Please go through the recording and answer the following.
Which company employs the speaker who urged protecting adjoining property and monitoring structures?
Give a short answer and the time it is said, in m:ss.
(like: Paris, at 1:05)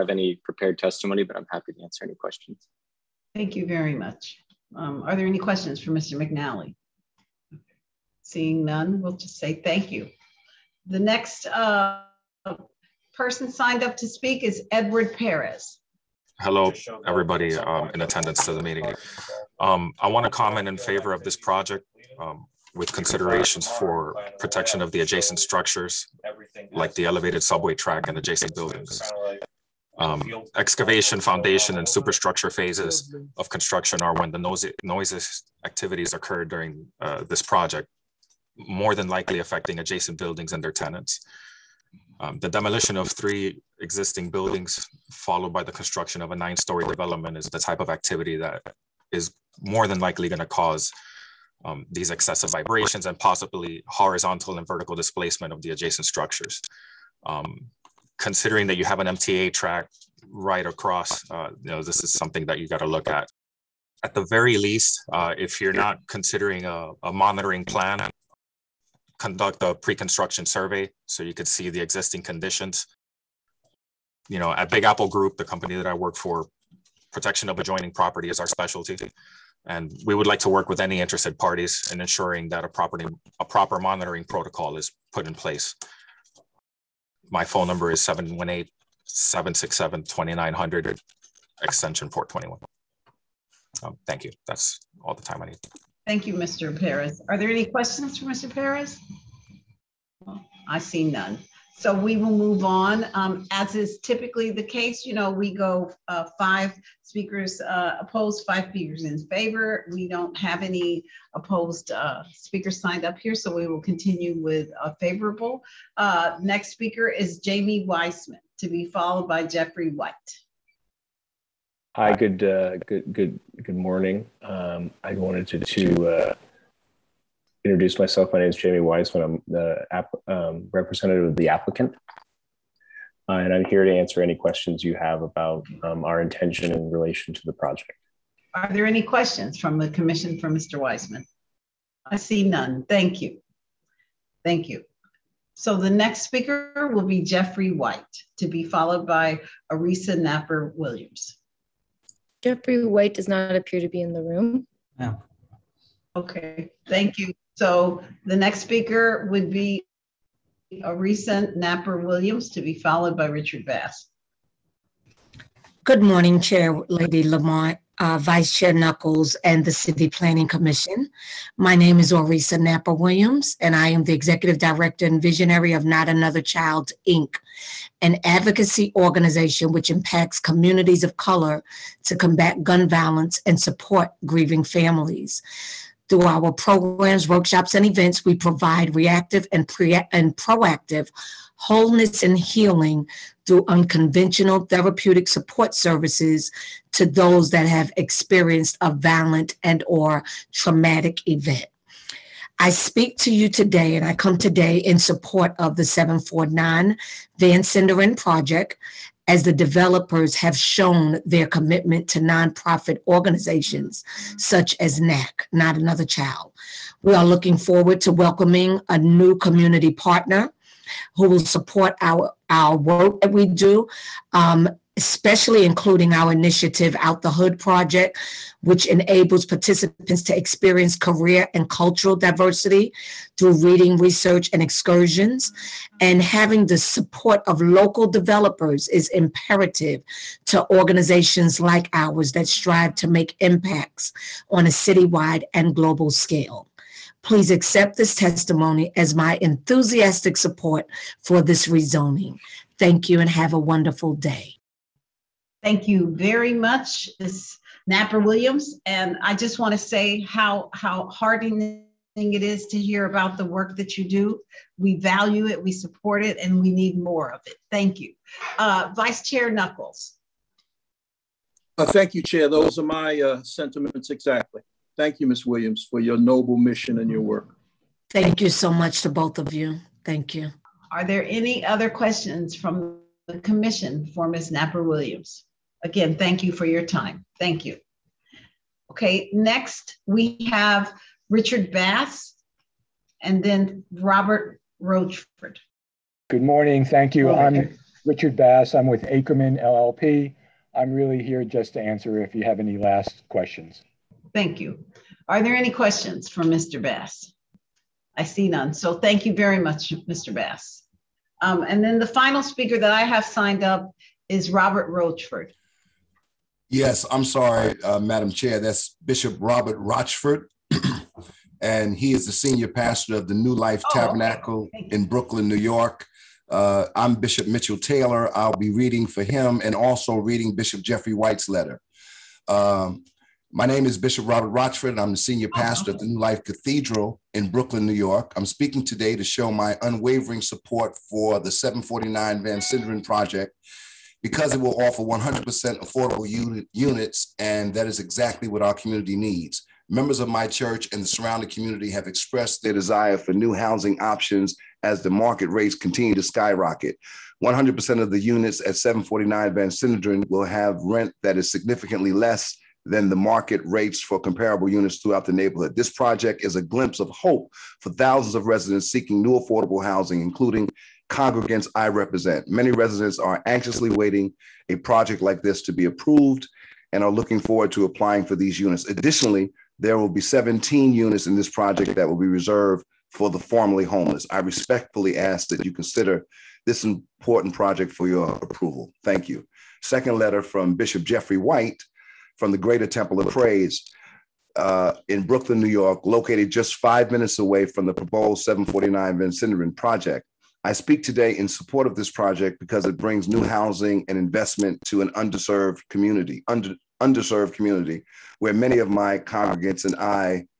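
Big Apple Group, at 1:14.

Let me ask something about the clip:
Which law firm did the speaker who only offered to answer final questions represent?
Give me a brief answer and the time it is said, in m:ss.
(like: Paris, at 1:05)
Ackerman LLP, at 4:59.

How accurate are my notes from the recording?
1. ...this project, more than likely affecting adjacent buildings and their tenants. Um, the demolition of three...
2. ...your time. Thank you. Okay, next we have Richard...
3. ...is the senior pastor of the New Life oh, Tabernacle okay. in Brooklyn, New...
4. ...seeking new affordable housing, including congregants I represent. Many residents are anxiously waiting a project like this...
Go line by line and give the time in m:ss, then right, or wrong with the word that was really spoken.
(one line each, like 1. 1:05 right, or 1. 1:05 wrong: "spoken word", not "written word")
1. 0:37 right
2. 4:46 right
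3. 5:22 right
4. 6:08 right.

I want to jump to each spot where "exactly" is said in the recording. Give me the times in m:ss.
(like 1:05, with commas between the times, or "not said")
4:34, 5:47.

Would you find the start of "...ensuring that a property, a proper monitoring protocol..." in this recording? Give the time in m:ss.
1:22.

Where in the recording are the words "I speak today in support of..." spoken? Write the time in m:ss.
6:40.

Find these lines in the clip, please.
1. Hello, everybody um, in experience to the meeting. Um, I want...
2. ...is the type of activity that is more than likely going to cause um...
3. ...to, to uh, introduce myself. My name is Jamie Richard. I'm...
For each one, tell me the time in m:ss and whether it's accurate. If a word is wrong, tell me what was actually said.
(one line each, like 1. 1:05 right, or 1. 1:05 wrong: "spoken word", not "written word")
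1. 0:16 wrong: "attendance", not "experience"
2. 0:47 right
3. 2:05 wrong: "Weissman", not "Richard".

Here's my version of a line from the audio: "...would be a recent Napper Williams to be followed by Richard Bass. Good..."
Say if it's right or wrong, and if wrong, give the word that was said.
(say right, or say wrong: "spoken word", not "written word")
right.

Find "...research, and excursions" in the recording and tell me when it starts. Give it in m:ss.
3:53.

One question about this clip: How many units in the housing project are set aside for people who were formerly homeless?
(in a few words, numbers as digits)
17.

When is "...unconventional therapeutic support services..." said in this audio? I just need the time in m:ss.
3:13.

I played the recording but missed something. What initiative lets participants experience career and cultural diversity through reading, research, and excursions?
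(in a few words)
Out the Hood Project.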